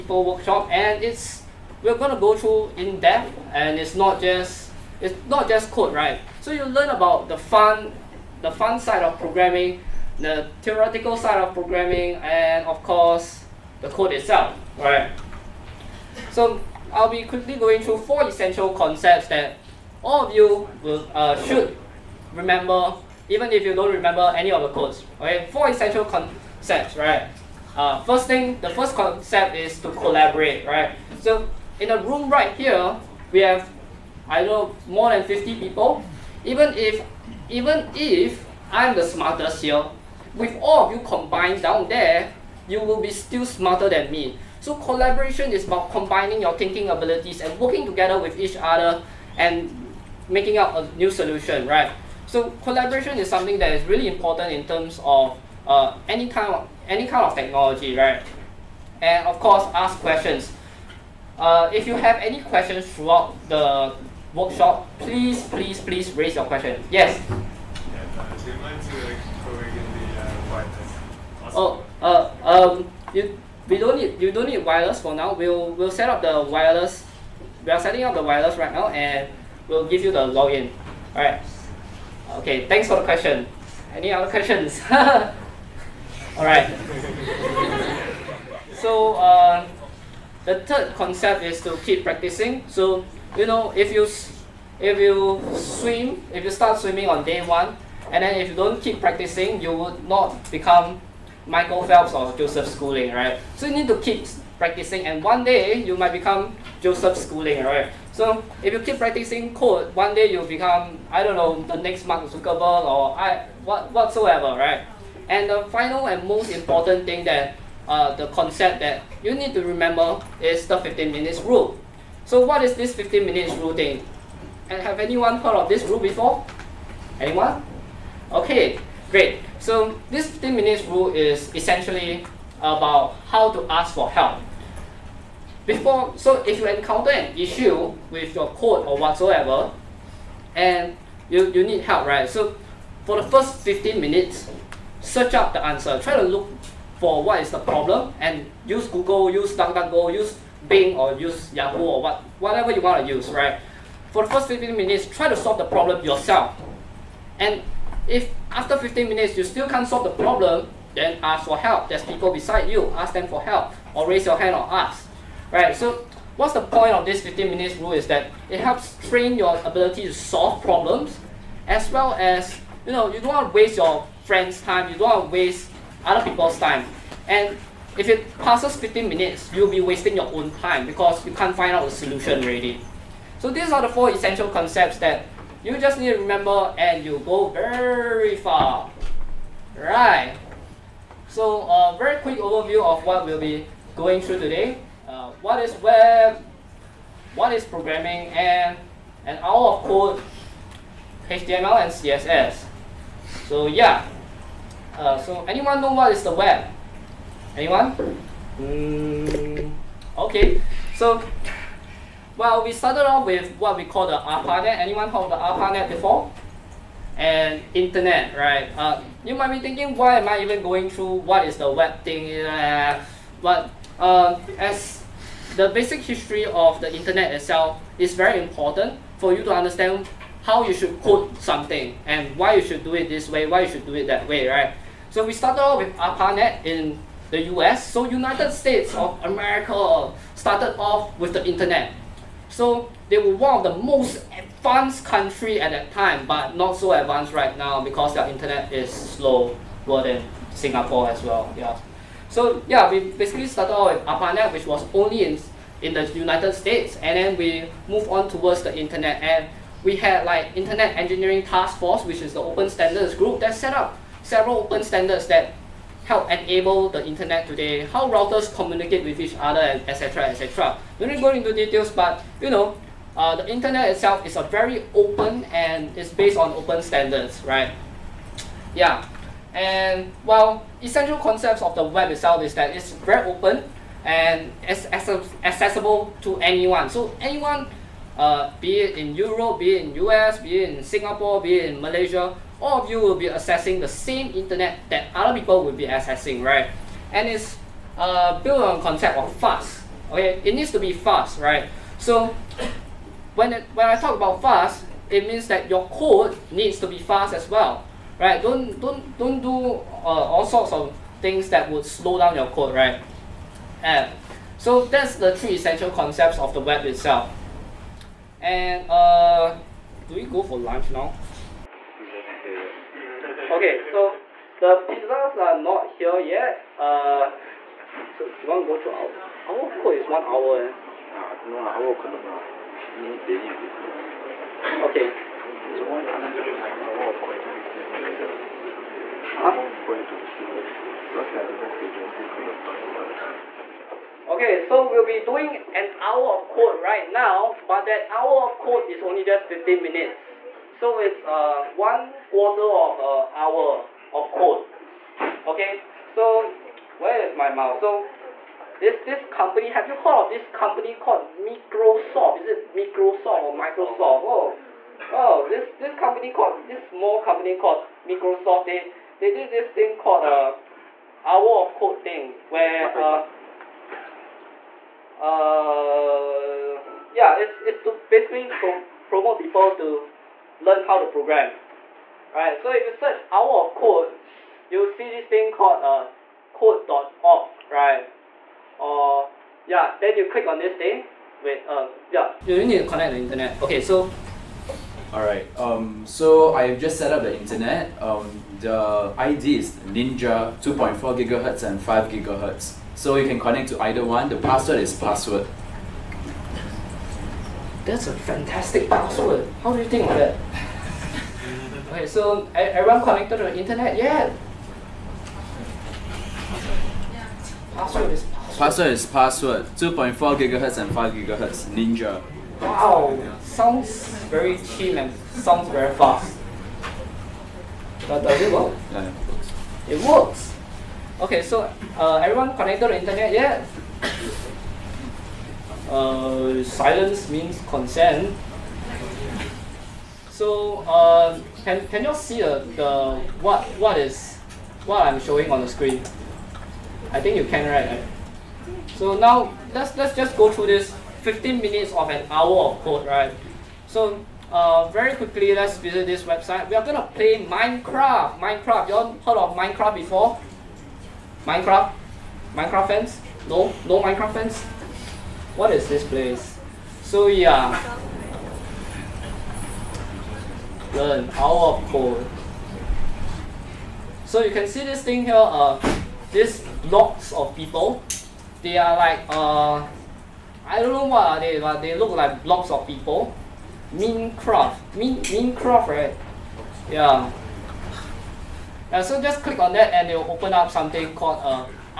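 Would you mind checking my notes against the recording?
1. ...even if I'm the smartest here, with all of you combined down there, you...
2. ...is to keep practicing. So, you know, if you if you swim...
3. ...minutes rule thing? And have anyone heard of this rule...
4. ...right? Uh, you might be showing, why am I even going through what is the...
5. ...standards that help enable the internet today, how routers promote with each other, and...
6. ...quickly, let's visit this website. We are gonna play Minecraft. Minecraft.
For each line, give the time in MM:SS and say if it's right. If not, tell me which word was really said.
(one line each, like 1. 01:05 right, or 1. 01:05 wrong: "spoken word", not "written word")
1. 00:37 right
2. 01:31 right
3. 02:03 right
4. 03:38 wrong: "thinking", not "showing"
5. 04:24 wrong: "communicate", not "promote"
6. 07:35 right.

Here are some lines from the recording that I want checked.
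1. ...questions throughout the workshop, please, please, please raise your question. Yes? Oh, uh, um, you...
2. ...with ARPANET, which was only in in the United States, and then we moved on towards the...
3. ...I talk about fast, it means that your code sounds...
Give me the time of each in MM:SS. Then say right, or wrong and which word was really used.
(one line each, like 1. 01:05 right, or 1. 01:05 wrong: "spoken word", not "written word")
1. 01:02 right
2. 04:13 right
3. 05:03 wrong: "needs", not "sounds".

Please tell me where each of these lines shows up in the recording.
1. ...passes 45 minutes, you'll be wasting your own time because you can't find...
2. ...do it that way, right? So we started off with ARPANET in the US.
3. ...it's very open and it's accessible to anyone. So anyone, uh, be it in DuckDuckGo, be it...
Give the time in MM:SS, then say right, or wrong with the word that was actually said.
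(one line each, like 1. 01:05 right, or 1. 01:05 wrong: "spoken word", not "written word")
1. 02:58 wrong: "15", not "45"
2. 03:53 right
3. 04:42 wrong: "Europe", not "DuckDuckGo".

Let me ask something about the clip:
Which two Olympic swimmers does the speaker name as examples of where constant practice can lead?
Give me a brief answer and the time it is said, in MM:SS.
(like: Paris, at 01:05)
Michael Phelps or Joseph Schooling, at 01:41.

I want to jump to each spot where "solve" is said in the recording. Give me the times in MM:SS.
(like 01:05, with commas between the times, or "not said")
02:35, 02:39, 02:50.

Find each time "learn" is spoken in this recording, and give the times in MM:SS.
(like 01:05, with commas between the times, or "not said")
00:06, 06:20, 07:50.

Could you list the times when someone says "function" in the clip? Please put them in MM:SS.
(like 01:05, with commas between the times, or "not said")
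not said.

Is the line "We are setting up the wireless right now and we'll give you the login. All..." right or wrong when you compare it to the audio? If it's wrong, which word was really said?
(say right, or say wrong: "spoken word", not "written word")
right.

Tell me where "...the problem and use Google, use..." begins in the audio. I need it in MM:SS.
02:27.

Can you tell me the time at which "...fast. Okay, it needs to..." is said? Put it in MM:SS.
04:59.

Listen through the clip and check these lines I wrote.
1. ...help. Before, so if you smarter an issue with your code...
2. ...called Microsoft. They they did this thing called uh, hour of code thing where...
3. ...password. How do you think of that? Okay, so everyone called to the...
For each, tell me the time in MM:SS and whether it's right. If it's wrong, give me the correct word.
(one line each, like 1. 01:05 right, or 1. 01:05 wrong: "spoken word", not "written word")
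1. 02:14 wrong: "encounter", not "smarter"
2. 06:07 right
3. 06:48 wrong: "connected", not "called".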